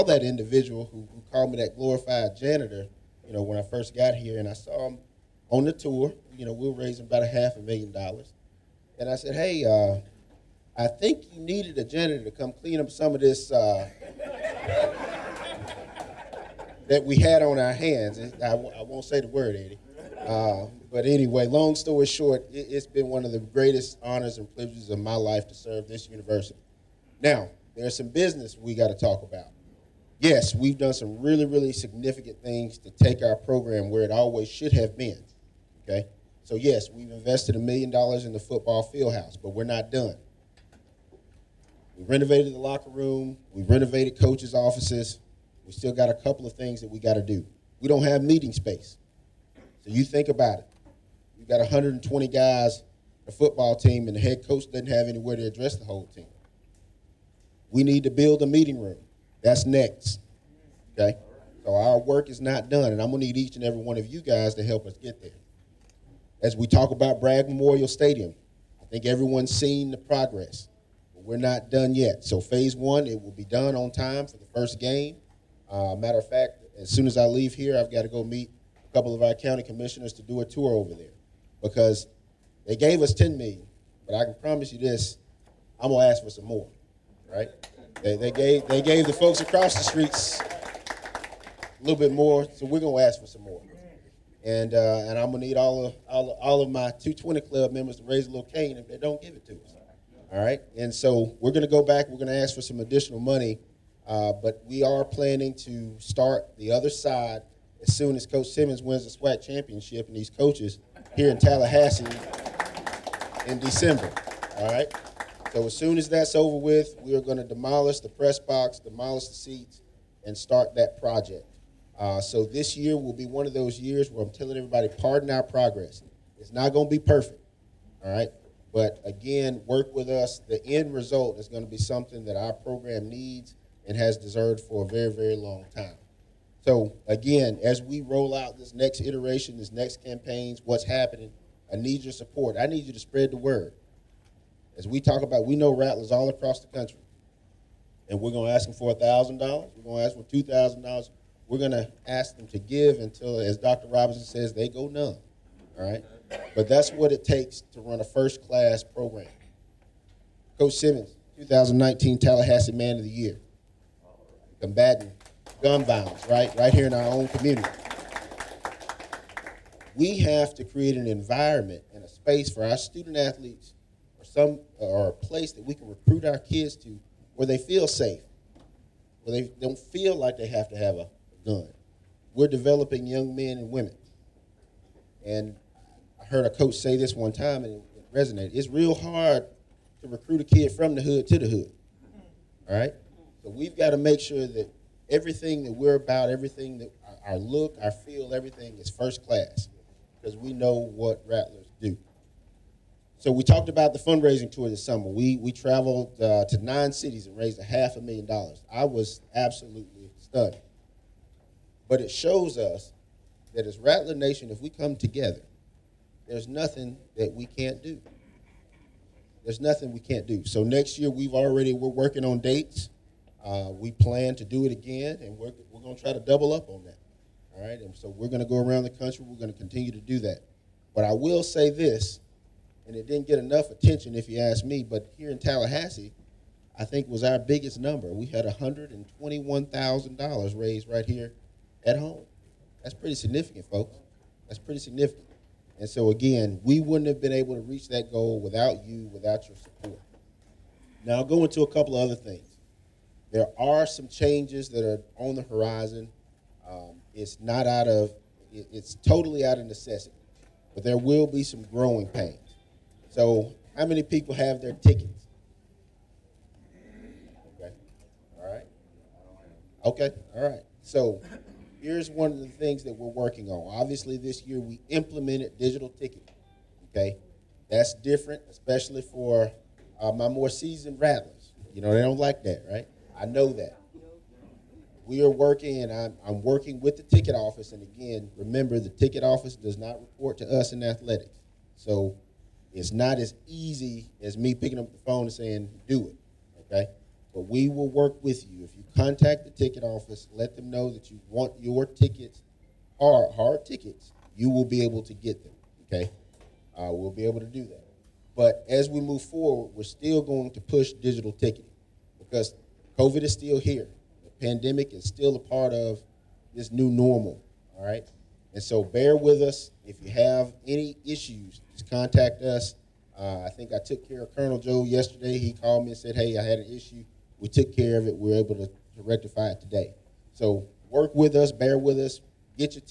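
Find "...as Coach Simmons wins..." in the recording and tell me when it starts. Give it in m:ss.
1:48.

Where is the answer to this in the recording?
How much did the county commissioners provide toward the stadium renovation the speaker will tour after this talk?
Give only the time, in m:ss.
1:23.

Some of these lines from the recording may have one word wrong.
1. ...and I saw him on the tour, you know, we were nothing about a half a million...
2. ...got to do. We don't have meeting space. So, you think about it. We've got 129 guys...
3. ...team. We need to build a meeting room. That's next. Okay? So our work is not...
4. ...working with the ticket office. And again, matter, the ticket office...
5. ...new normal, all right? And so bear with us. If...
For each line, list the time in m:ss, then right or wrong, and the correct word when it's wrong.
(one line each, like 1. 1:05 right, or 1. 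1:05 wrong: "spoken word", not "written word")
1. 0:04 wrong: "raising", not "nothing"
2. 0:46 wrong: "120", not "129"
3. 0:56 right
4. 4:46 wrong: "remember", not "matter"
5. 5:16 right.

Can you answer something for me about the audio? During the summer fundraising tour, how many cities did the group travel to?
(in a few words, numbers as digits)
9.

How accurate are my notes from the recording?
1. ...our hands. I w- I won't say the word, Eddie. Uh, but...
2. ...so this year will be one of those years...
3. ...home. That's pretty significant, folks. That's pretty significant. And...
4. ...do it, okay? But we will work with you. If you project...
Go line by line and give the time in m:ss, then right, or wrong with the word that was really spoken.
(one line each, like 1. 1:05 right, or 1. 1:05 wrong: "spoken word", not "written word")
1. 0:17 right
2. 2:02 right
3. 4:01 right
4. 4:55 wrong: "contact", not "project".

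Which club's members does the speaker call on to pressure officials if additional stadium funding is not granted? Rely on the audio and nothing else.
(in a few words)
220 Club.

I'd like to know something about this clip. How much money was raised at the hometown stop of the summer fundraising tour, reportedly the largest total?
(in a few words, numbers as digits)
$121,000.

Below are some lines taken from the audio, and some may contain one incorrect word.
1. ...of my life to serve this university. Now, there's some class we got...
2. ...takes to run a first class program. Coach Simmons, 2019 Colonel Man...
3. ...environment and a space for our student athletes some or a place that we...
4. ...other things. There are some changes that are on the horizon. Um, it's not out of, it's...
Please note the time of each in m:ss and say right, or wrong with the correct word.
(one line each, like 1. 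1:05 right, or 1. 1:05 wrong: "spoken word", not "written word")
1. 0:24 wrong: "business", not "class"
2. 2:37 wrong: "Tallahassee", not "Colonel"
3. 2:51 right
4. 4:12 right.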